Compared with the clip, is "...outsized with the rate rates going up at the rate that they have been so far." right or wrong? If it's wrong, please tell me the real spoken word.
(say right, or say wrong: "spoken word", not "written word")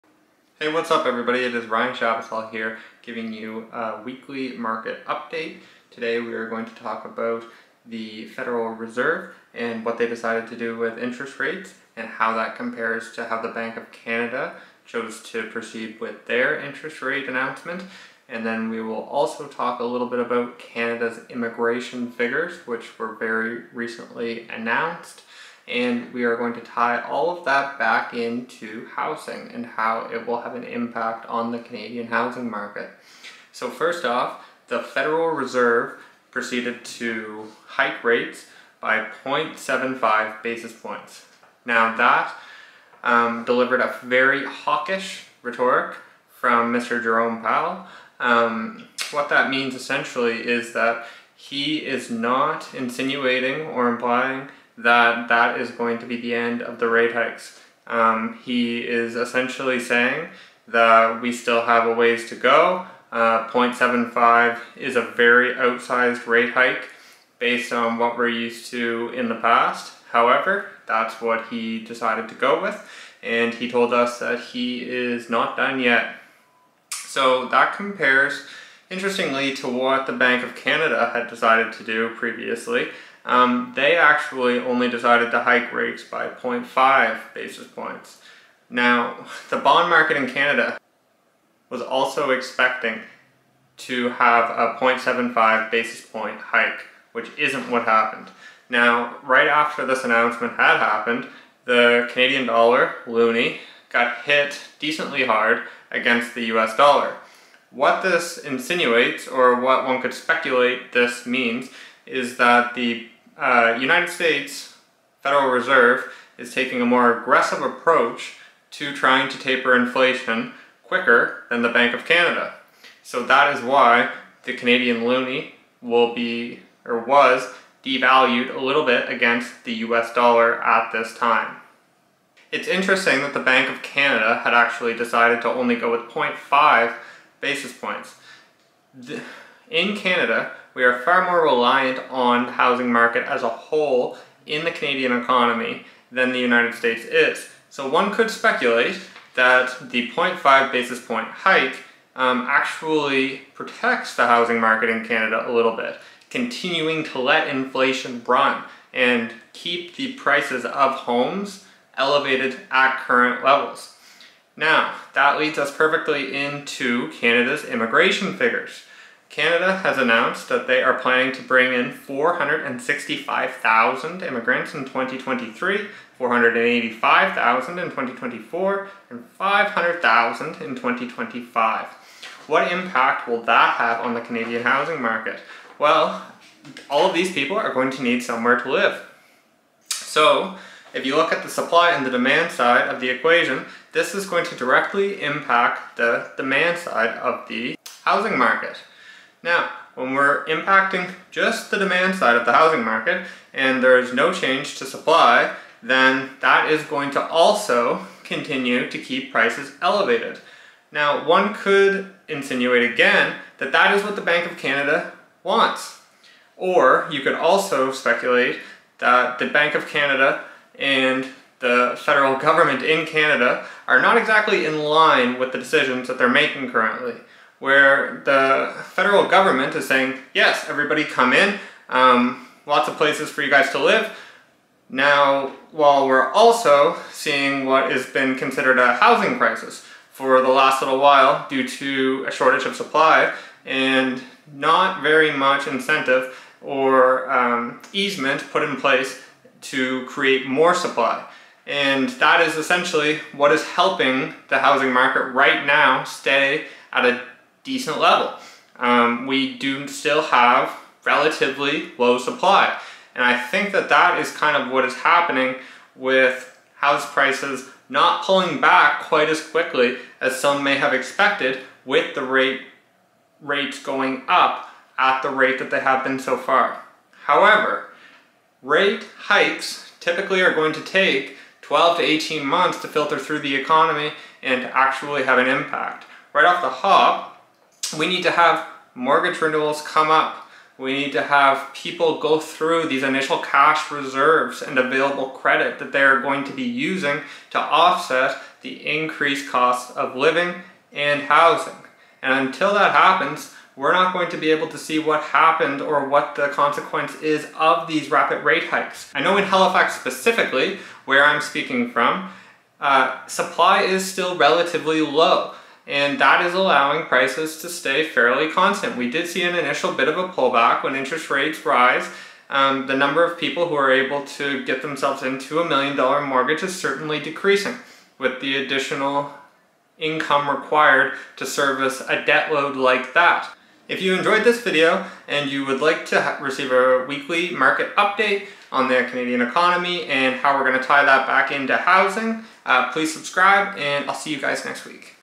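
wrong: "expected", not "outsized".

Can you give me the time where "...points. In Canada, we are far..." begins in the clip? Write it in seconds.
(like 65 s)
137 s.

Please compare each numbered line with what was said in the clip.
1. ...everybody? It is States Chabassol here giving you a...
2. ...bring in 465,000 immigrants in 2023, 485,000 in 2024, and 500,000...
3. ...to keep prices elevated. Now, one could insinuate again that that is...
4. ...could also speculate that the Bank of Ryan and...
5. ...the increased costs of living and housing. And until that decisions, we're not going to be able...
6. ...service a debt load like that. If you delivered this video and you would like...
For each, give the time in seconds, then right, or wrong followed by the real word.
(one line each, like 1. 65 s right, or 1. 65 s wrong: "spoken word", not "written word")
1. 1 s wrong: "Ryan", not "States"
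2. 171 s right
3. 208 s right
4. 217 s wrong: "Canada", not "Ryan"
5. 298 s wrong: "happens", not "decisions"
6. 331 s wrong: "enjoyed", not "delivered".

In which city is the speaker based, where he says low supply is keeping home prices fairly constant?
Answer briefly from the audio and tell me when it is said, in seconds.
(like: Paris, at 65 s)
Halifax, at 309 s.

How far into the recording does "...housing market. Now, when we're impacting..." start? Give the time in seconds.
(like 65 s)
198 s.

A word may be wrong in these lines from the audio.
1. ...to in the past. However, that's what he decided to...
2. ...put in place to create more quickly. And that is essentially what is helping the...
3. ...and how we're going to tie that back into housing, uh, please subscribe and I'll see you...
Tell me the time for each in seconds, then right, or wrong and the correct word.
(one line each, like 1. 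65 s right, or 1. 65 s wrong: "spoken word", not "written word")
1. 68 s right
2. 248 s wrong: "supply", not "quickly"
3. 340 s right.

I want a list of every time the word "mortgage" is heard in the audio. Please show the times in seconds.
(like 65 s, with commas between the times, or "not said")
288 s, 326 s.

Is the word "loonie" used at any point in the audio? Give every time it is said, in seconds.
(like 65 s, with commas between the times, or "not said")
103 s, 125 s.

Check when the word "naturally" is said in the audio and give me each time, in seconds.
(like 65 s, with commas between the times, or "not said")
not said.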